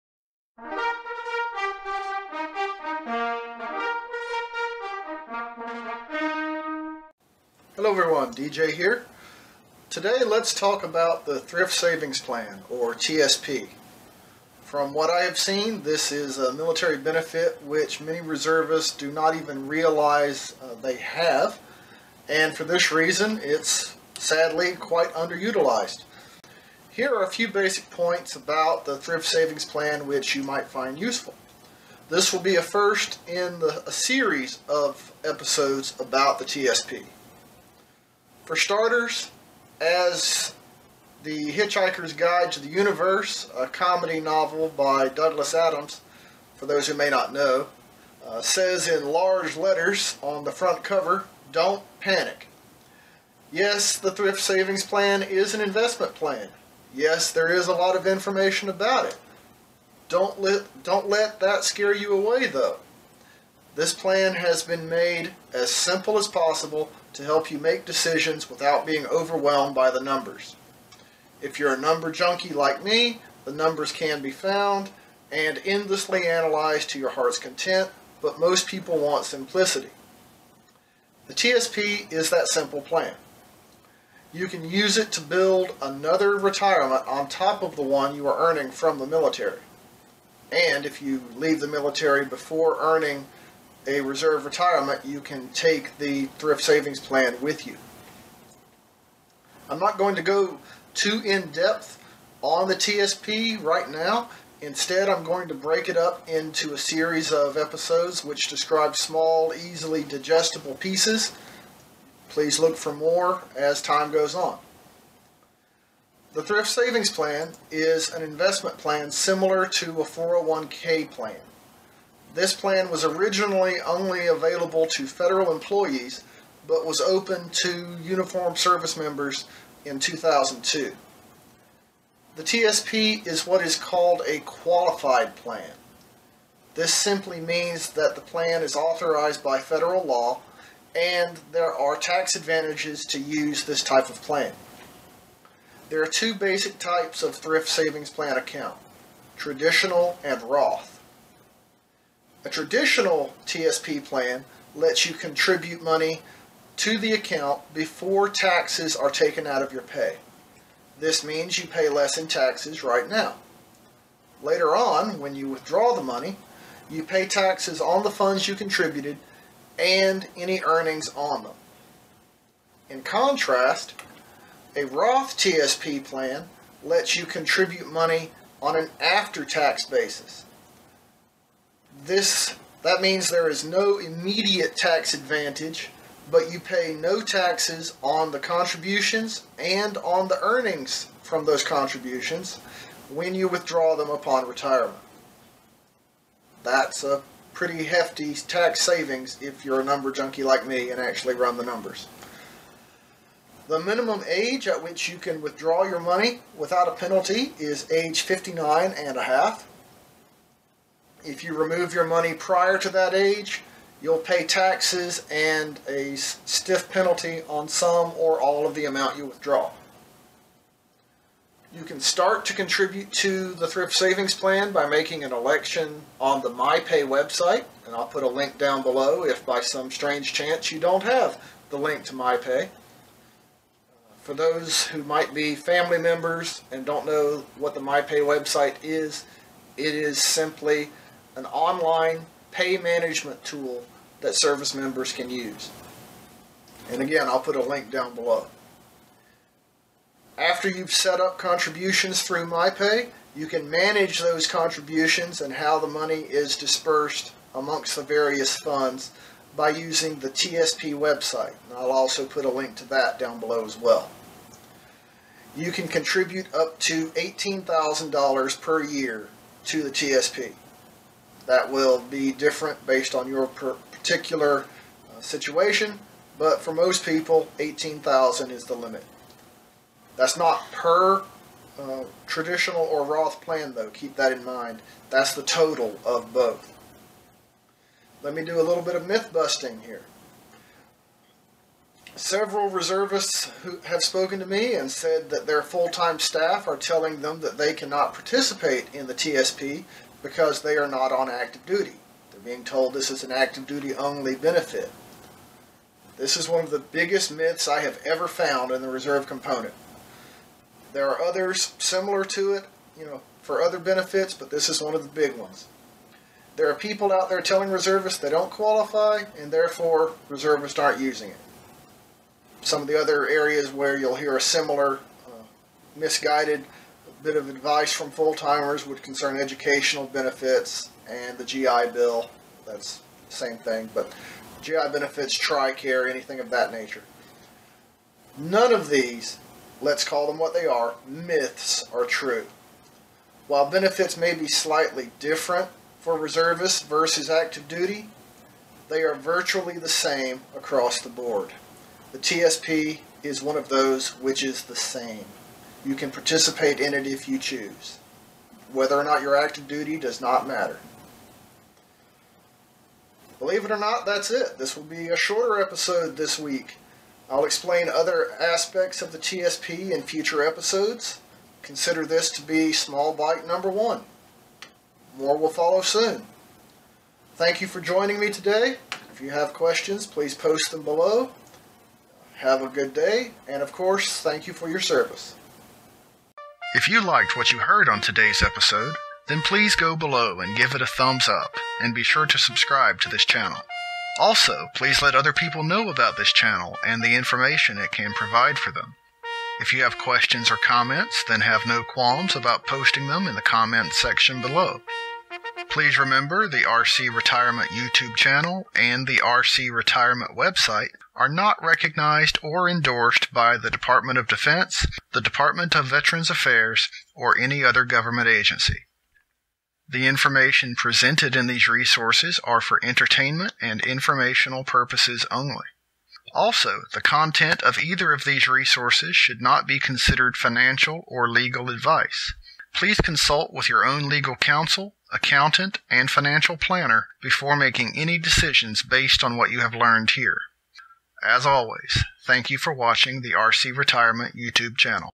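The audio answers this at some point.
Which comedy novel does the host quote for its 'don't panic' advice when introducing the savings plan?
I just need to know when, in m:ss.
0:41.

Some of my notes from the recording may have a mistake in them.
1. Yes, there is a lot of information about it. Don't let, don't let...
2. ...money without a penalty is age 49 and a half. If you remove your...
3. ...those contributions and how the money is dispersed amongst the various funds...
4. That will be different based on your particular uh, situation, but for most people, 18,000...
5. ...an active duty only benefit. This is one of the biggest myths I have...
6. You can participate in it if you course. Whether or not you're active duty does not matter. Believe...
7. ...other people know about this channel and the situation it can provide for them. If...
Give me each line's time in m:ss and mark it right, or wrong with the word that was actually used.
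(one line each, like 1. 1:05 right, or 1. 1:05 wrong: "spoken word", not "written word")
1. 0:56 right
2. 3:25 wrong: "59", not "49"
3. 4:14 right
4. 4:31 right
5. 5:03 right
6. 5:55 wrong: "choose", not "course"
7. 6:35 wrong: "information", not "situation".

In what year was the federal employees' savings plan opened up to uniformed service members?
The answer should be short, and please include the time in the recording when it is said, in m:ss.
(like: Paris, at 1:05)
2002, at 2:09.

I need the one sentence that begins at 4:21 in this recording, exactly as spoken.
And I'll also put a link to that down below as well.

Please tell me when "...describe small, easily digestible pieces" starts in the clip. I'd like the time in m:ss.
1:48.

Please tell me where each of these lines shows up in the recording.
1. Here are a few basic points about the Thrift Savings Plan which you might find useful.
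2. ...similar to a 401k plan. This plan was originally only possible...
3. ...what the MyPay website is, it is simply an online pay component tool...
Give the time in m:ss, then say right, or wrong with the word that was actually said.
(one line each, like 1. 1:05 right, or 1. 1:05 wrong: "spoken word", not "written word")
1. 0:26 right
2. 1:59 wrong: "available", not "possible"
3. 3:57 wrong: "management", not "component".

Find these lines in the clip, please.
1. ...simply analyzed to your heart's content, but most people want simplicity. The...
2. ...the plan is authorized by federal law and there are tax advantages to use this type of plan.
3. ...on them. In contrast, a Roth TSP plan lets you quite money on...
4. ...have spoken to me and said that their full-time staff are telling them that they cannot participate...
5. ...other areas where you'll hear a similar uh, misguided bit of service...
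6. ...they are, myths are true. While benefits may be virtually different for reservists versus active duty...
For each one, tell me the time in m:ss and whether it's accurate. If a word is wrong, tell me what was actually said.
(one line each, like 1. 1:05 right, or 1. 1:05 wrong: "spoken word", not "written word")
1. 1:15 wrong: "endlessly", not "simply"
2. 2:18 right
3. 2:51 wrong: "contribute", not "quite"
4. 4:53 right
5. 5:22 wrong: "advice", not "service"
6. 5:40 wrong: "slightly", not "virtually".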